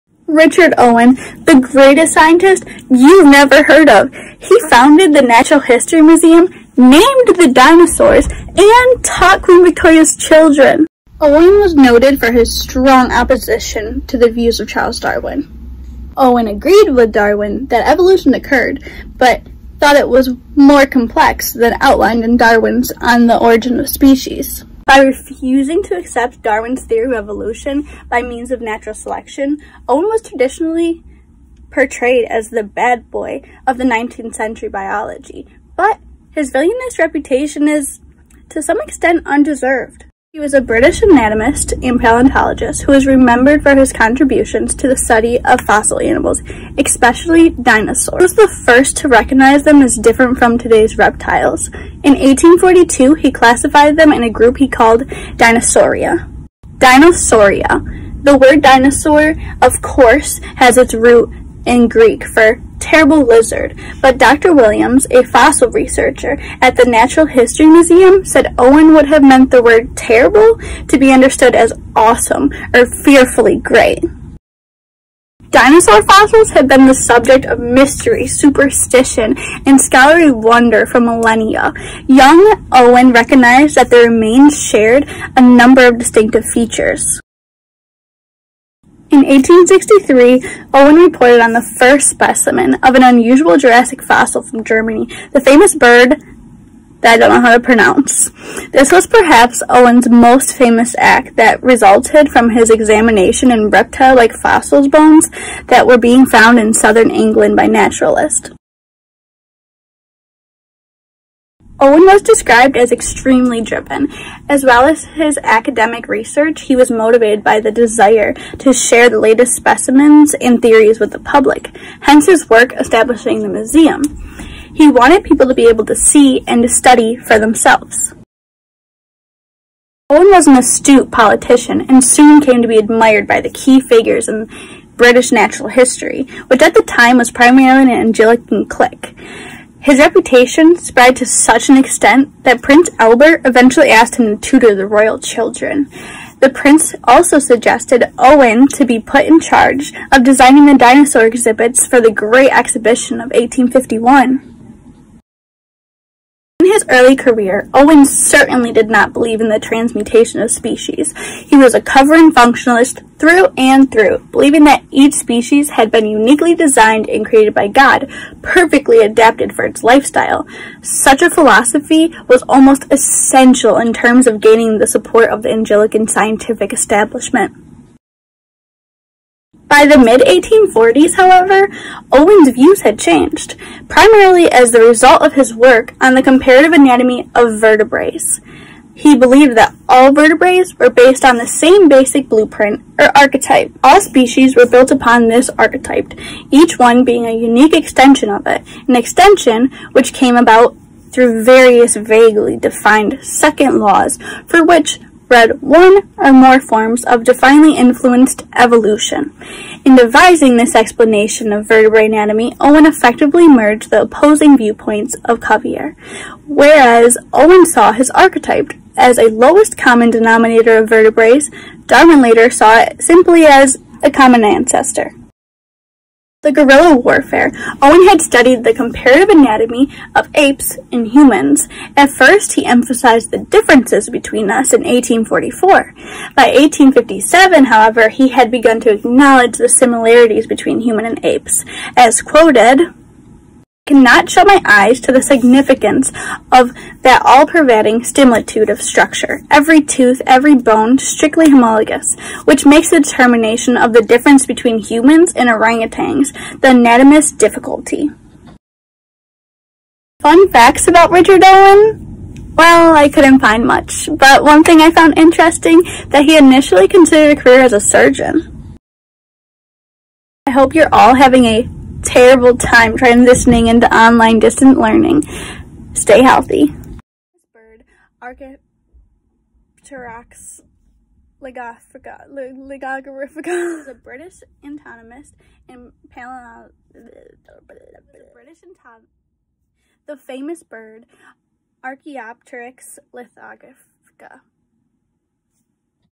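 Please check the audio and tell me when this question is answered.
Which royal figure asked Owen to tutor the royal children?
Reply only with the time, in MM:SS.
02:22.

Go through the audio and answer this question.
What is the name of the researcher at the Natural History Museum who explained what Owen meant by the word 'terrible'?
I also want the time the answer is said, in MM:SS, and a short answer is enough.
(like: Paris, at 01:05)
Dr. Williams, at 01:04.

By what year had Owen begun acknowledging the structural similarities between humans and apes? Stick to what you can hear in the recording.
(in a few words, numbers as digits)
1857.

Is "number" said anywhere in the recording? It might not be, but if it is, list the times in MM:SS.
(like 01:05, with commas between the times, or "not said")
01:25.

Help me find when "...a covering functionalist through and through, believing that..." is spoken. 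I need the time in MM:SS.
02:41.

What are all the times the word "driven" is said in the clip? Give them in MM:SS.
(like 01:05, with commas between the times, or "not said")
01:53.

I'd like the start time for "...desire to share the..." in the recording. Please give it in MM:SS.
01:57.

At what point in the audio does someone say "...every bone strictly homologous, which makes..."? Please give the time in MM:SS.
04:10.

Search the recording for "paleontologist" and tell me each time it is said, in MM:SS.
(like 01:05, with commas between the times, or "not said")
00:41, 04:46.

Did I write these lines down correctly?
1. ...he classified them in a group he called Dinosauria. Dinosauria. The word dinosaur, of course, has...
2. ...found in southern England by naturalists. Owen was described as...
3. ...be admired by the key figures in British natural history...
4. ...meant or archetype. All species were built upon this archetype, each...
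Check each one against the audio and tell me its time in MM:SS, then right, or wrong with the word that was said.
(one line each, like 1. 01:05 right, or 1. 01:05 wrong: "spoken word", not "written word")
1. 00:53 right
2. 01:46 right
3. 02:12 right
4. 03:12 wrong: "blueprint", not "meant".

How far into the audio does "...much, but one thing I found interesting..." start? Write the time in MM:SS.
04:23.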